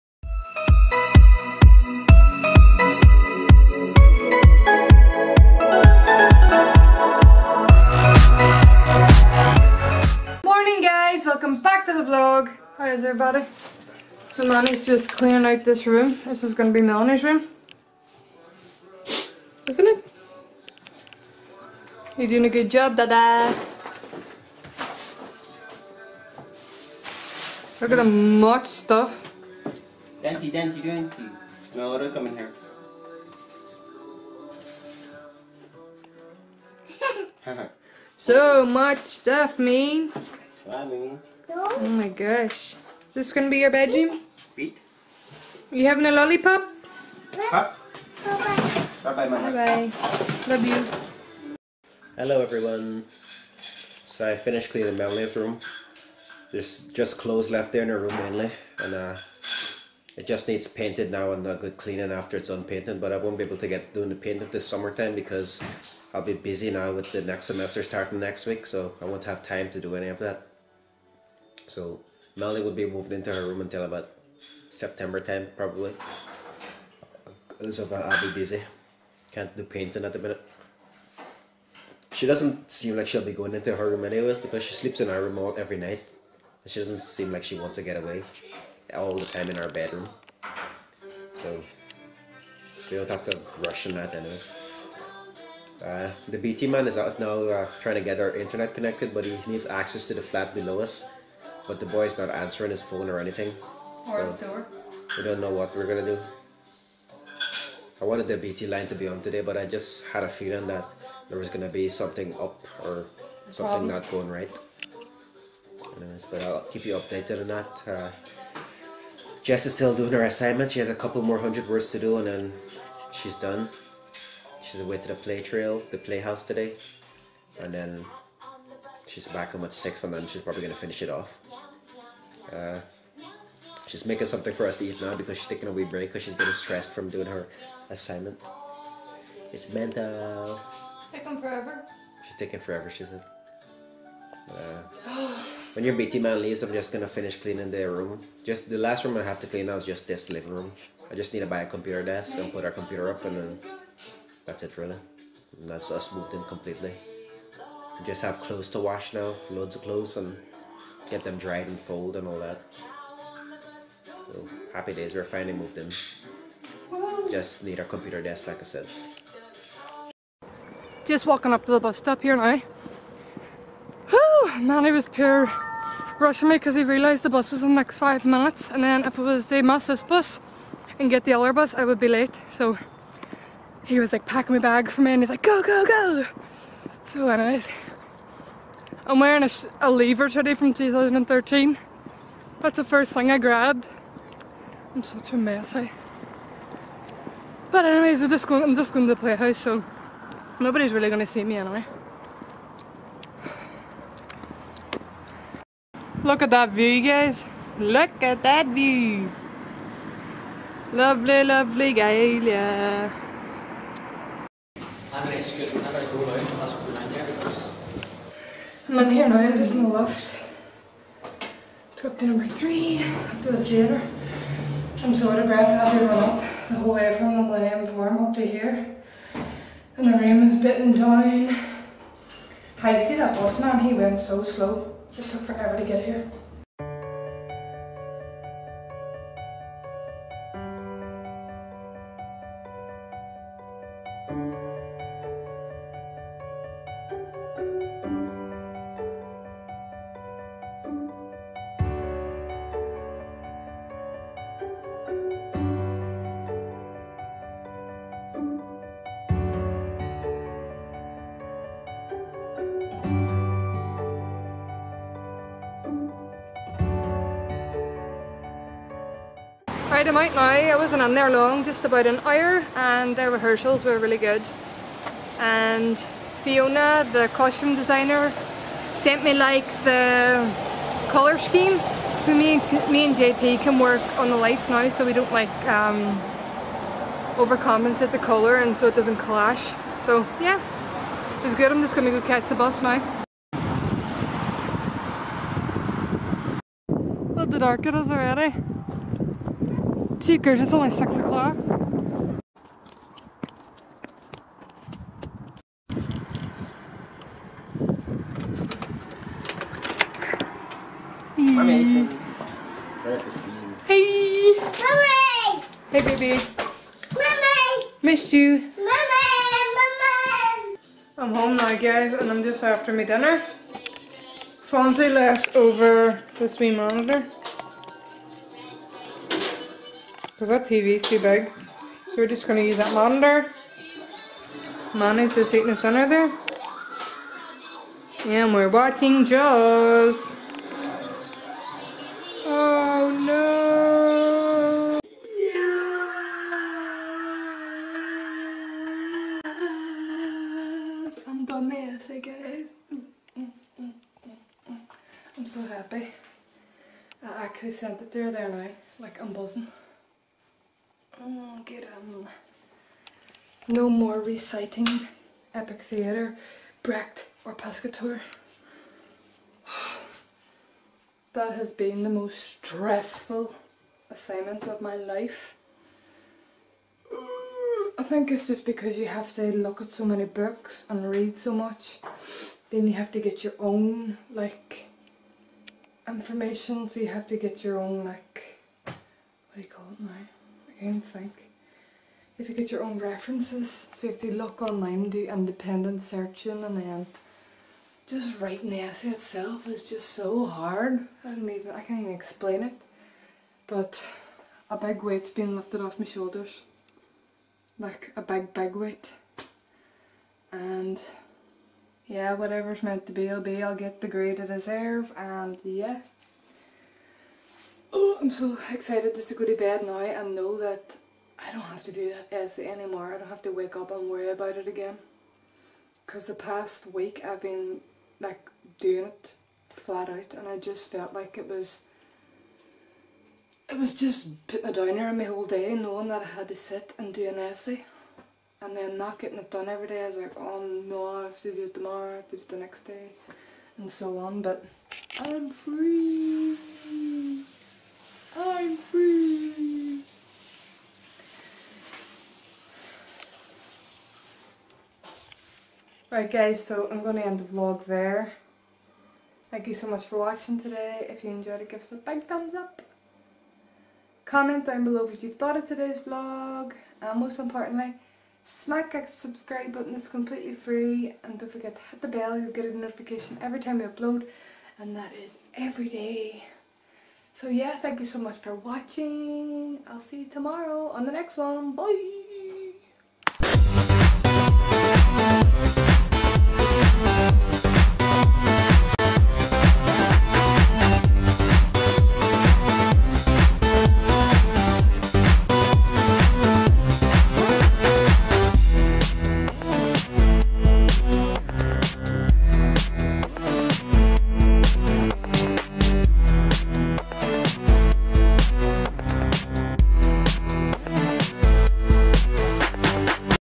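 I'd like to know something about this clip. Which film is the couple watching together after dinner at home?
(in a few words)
Jaws.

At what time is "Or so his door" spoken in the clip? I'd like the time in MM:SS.
01:44.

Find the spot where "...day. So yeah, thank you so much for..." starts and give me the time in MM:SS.
07:55.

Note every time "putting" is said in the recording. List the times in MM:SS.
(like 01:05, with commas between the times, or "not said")
07:14.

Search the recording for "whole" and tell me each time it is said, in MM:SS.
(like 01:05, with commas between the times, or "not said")
03:46, 07:15.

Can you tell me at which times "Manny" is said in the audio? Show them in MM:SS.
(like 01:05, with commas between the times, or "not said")
02:54, 05:34.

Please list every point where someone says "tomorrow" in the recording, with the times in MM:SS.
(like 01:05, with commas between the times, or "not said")
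07:21, 08:00.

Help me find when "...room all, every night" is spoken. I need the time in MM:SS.
01:25.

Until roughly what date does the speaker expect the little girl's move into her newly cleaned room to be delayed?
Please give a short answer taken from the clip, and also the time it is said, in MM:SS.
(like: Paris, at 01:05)
September 10, at 01:14.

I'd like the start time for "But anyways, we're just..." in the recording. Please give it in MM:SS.
03:17.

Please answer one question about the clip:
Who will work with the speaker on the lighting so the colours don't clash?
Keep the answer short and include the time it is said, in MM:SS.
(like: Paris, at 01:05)
JP, at 04:43.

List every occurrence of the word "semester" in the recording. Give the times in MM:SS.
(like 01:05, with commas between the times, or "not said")
01:07.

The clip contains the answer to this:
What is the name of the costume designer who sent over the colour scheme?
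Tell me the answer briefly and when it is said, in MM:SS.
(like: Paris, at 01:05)
Fiona, at 04:36.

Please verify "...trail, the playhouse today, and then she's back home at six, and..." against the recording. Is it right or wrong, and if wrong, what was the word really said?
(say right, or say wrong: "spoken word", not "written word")
right.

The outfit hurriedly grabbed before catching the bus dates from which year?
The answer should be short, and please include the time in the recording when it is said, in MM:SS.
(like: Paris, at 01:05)
2013, at 03:10.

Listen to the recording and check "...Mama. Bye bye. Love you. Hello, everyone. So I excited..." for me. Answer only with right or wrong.
wrong.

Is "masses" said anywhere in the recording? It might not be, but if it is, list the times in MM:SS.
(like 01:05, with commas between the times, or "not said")
02:59.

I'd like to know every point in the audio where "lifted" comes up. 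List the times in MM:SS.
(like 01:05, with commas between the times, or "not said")
06:45.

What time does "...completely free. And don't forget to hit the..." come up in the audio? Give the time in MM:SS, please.
07:50.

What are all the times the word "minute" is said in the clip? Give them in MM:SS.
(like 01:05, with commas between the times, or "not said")
01:20, 02:58.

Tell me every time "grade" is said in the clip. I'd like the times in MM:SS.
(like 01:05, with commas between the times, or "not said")
06:54.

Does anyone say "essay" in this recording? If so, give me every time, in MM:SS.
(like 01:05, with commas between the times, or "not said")
06:38, 07:02, 07:17.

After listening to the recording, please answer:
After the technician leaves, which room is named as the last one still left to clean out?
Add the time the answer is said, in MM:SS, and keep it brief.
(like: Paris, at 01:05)
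Living room, at 02:30.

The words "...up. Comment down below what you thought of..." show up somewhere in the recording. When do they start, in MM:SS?
07:42.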